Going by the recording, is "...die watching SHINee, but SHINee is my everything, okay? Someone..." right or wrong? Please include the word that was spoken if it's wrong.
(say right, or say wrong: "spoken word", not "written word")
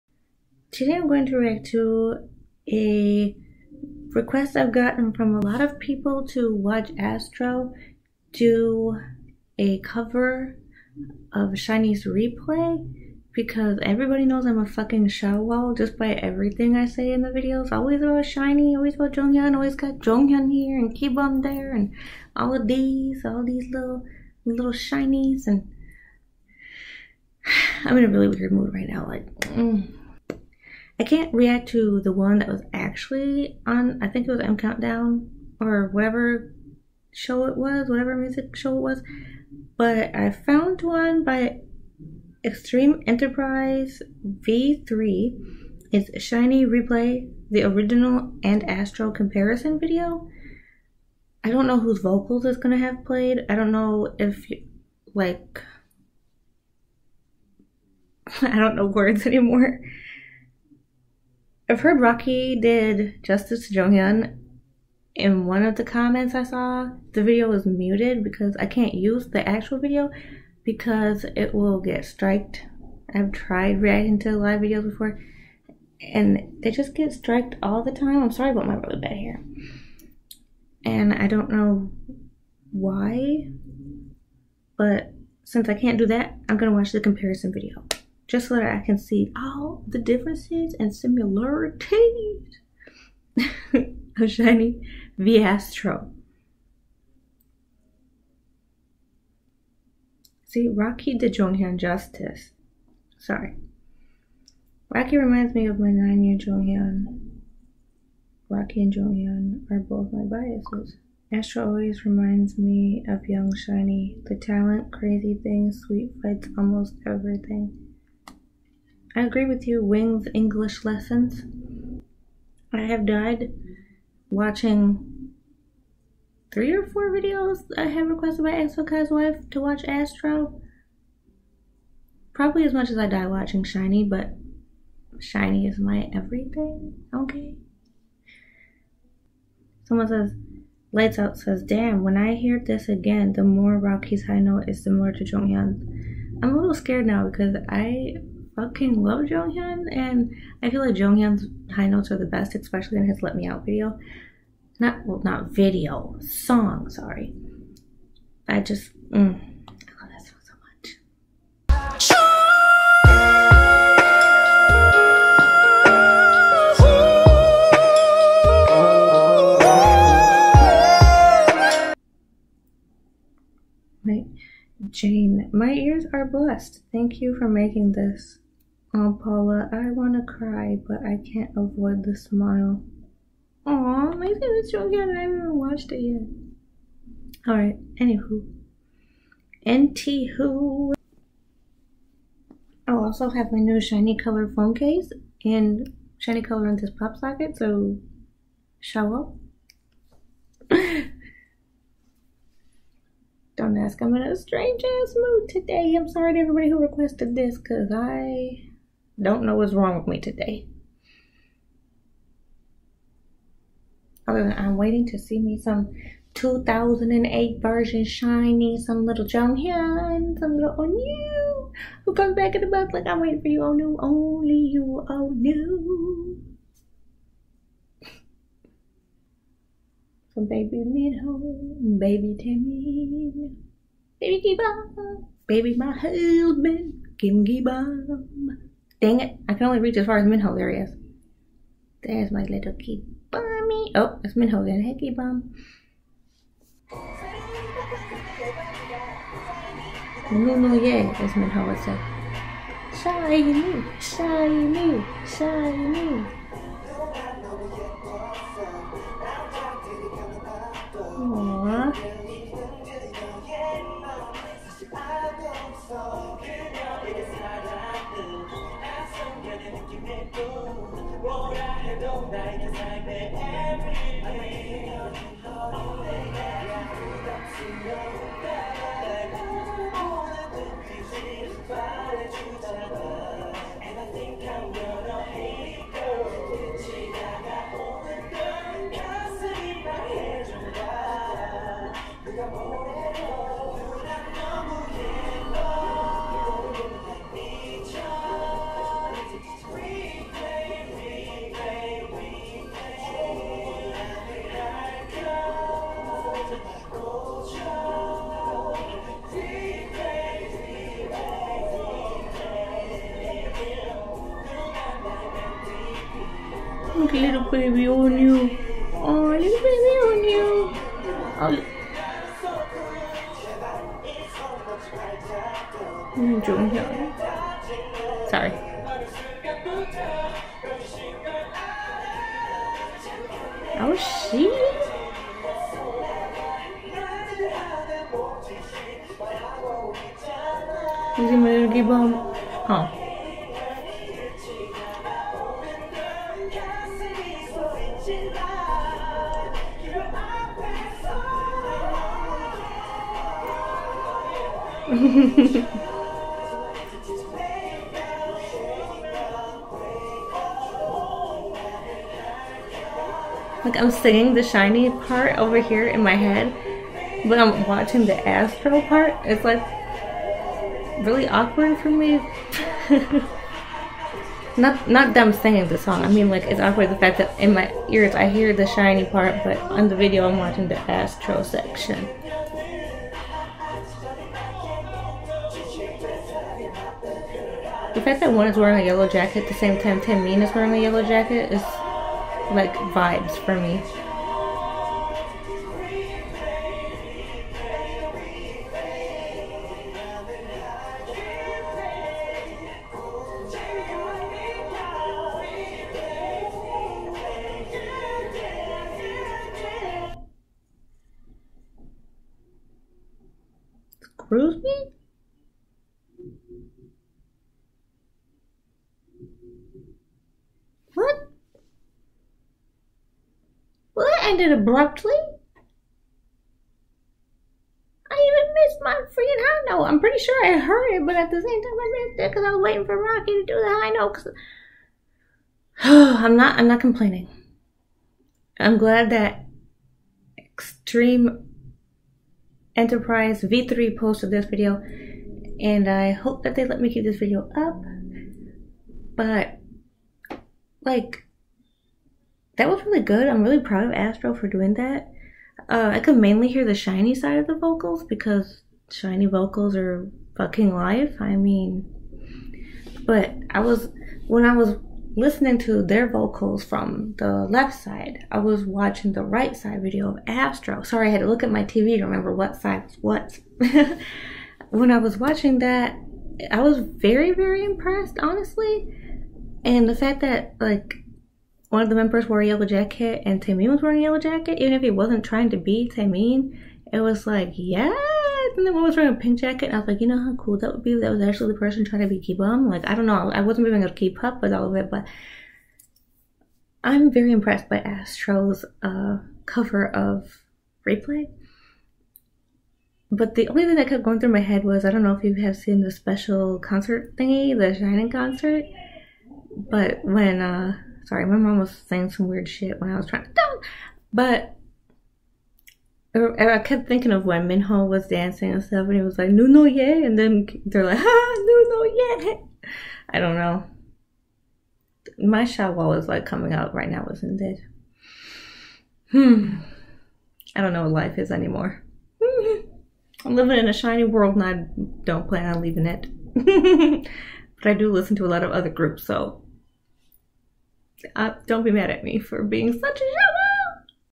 right.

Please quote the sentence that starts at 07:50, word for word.
Sorry, I had to look at my TV to remember what side was what.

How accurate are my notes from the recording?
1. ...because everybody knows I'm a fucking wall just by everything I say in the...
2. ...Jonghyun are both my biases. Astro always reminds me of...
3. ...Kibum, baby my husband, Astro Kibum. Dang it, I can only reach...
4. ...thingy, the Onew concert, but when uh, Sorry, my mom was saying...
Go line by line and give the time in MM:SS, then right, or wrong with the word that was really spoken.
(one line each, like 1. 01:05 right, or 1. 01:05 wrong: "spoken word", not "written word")
1. 00:13 right
2. 01:48 right
3. 03:54 wrong: "Kim", not "Astro"
4. 08:27 wrong: "Shining", not "Onew".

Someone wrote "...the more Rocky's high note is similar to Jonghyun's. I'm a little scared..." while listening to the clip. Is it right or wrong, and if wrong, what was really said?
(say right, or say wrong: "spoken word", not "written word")
right.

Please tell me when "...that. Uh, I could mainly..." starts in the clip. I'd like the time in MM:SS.
07:34.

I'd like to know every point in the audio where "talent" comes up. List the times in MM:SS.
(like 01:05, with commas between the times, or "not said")
01:54.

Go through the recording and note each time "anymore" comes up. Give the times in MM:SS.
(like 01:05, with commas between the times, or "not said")
00:59, 08:51.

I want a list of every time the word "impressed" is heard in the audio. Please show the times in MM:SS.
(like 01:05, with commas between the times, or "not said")
07:57, 08:17.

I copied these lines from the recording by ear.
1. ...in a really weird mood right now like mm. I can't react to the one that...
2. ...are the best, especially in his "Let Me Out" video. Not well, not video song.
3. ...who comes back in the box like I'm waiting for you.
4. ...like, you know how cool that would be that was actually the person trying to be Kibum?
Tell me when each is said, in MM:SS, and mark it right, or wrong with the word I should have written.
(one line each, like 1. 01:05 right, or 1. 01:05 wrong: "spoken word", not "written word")
1. 00:27 right
2. 02:32 right
3. 03:42 right
4. 08:09 right.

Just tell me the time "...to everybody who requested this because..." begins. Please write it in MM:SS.
03:26.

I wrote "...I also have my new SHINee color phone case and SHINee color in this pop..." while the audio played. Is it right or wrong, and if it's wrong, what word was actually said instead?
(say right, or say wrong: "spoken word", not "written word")
right.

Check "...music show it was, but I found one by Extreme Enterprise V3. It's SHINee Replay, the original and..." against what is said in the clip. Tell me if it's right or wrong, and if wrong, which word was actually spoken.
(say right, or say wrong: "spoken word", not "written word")
right.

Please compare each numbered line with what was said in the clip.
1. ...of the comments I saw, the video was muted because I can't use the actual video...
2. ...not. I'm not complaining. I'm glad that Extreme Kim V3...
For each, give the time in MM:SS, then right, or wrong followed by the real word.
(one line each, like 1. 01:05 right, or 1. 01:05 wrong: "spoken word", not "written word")
1. 01:05 right
2. 07:16 wrong: "Enterprise", not "Kim".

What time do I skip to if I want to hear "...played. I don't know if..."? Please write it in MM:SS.
00:53.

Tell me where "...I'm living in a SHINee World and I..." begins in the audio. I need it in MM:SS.
08:53.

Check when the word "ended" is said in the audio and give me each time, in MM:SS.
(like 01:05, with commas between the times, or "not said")
07:04.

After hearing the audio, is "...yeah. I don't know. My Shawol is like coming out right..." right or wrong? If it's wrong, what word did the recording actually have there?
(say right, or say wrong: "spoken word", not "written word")
right.